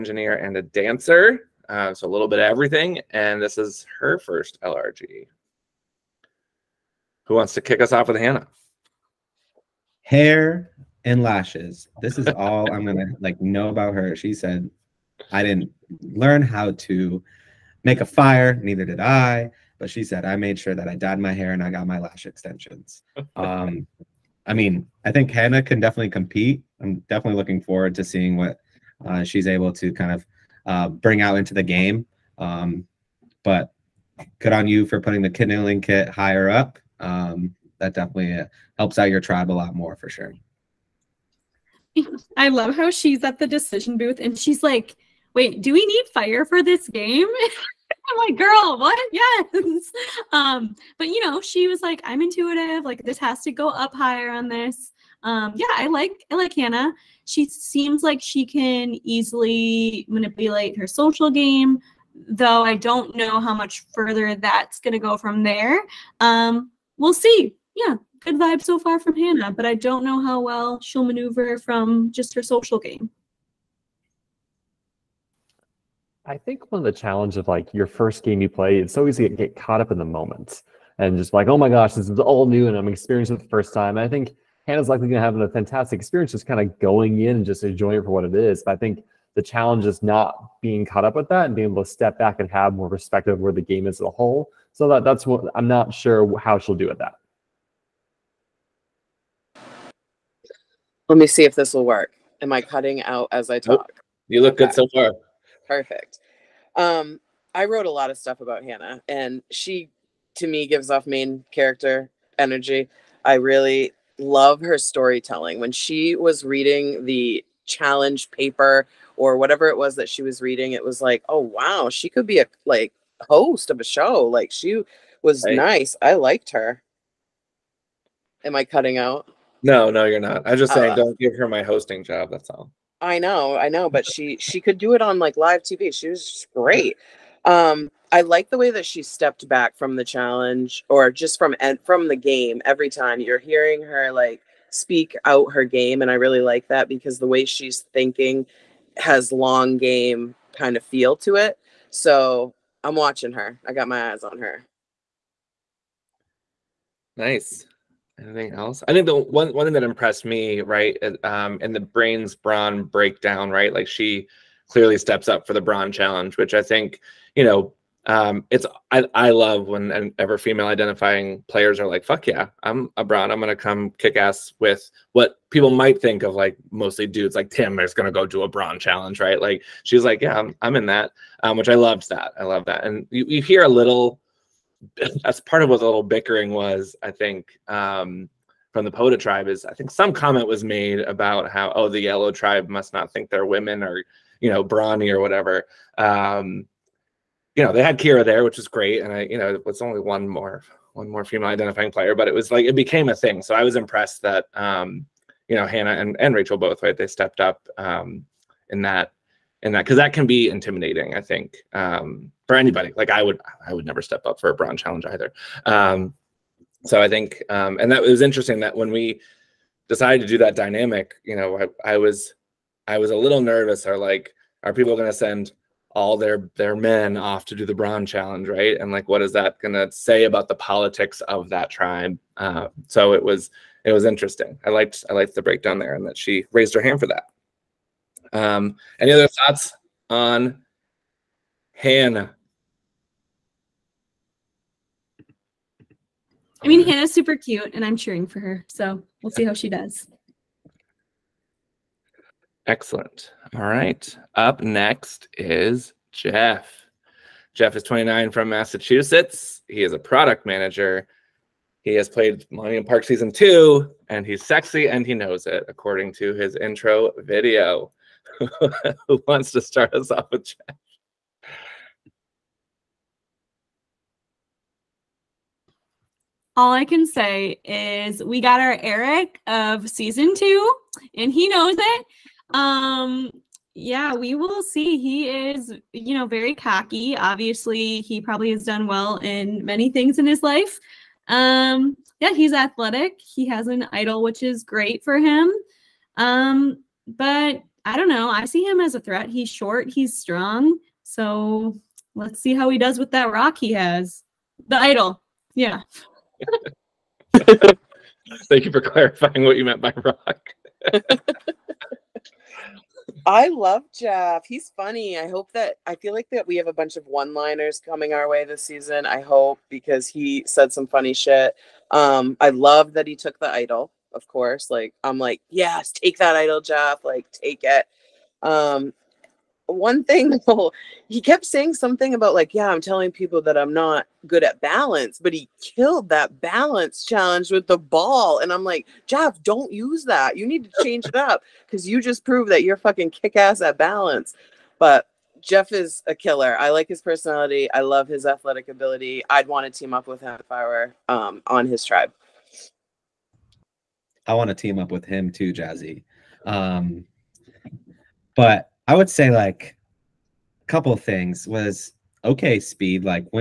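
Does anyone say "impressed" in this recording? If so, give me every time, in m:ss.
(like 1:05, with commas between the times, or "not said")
2:39, 3:23.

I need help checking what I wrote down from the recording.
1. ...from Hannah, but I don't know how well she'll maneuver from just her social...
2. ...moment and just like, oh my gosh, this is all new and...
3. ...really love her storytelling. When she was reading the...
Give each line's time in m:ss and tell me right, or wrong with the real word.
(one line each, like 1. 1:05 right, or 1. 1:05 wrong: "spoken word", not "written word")
1. 1:08 right
2. 1:20 right
3. 1:53 right.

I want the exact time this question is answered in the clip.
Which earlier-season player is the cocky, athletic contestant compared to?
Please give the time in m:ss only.
4:38.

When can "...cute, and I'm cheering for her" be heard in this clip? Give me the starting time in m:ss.
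4:07.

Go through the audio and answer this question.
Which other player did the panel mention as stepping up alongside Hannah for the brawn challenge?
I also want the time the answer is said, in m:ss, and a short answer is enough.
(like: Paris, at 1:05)
Rachel, at 3:26.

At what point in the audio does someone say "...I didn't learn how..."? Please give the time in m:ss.
0:15.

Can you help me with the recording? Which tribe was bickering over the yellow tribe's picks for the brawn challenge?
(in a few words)
Poda.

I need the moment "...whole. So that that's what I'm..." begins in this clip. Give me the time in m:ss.
1:34.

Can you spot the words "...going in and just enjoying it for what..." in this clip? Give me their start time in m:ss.
1:26.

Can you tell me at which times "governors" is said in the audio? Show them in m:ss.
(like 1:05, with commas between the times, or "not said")
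not said.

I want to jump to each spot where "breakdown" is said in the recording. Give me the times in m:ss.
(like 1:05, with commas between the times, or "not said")
2:42, 3:55.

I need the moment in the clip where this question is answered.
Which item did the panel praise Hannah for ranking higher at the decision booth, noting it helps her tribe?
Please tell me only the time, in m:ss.
0:35.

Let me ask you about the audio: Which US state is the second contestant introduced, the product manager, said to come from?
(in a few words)
Massachusetts.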